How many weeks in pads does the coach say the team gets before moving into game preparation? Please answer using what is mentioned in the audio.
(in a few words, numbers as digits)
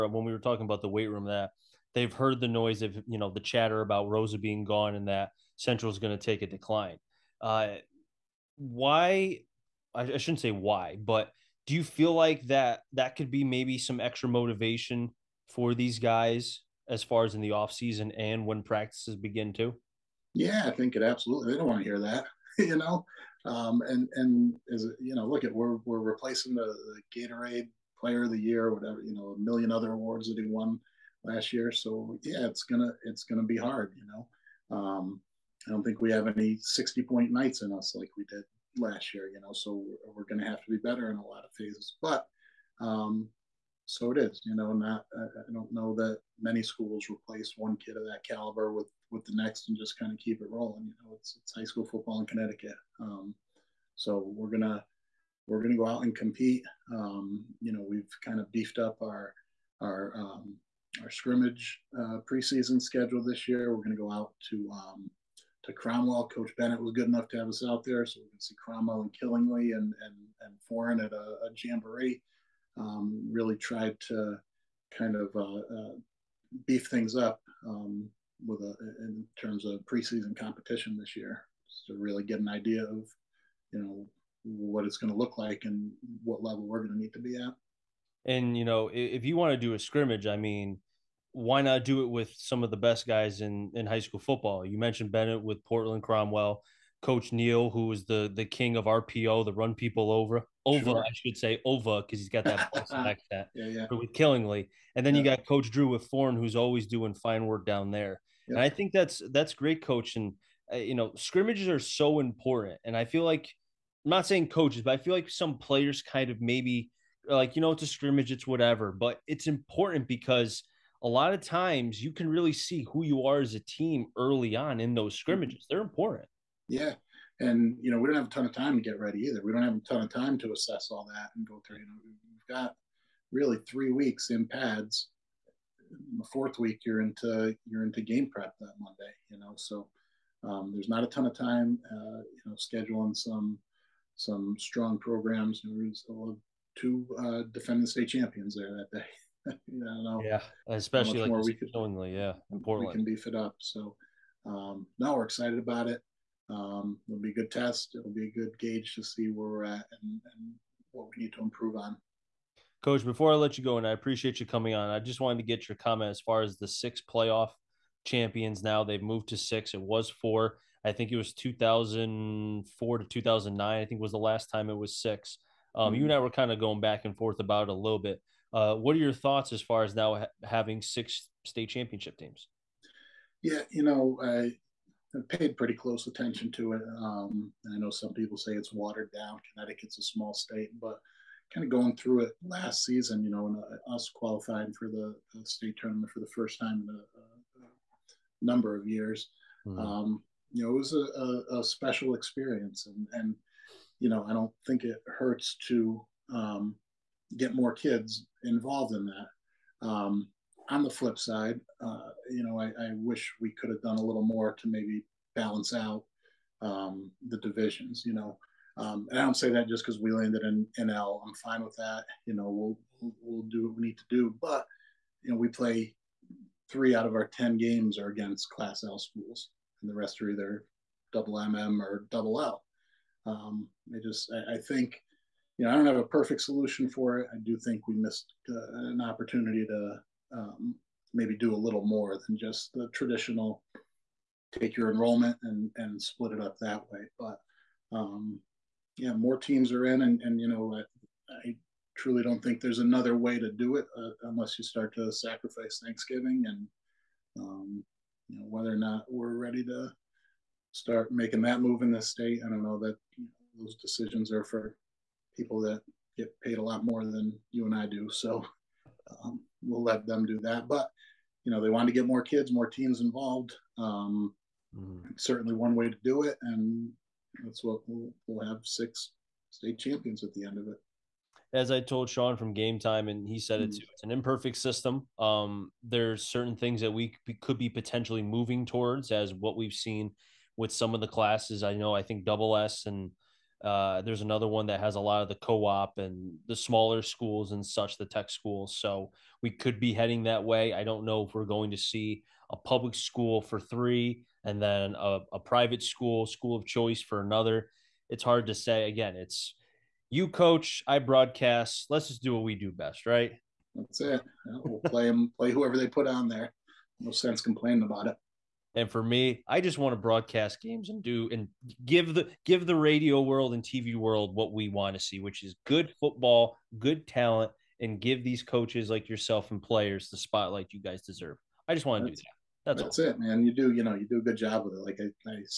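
3.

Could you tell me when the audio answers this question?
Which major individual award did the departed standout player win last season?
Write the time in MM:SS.
00:27.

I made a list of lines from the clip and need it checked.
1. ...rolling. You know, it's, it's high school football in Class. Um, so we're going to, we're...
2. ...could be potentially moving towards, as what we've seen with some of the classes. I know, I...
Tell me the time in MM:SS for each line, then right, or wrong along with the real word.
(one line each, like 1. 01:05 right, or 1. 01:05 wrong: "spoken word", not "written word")
1. 00:50 wrong: "Connecticut", not "Class"
2. 04:47 right.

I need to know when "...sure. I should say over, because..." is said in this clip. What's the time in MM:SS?
01:40.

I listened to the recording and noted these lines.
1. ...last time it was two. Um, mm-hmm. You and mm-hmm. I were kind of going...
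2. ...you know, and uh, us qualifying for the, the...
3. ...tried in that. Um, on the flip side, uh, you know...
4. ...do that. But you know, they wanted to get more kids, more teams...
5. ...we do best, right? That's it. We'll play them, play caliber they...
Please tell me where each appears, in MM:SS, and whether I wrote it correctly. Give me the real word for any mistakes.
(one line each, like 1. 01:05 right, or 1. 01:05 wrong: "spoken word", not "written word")
1. 02:54 wrong: "six", not "two"
2. 03:13 right
3. 03:28 wrong: "involved", not "tried"
4. 04:30 right
5. 05:12 wrong: "whoever", not "caliber".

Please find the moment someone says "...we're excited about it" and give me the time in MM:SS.
02:35.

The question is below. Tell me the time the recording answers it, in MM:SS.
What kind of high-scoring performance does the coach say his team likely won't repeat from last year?
00:36.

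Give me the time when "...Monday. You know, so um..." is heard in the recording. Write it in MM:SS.
02:18.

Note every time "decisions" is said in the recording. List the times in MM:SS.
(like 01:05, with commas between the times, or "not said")
04:23.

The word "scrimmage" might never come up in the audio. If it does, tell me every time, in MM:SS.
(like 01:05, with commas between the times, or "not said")
01:01, 01:29, 01:51, 01:57, 02:05.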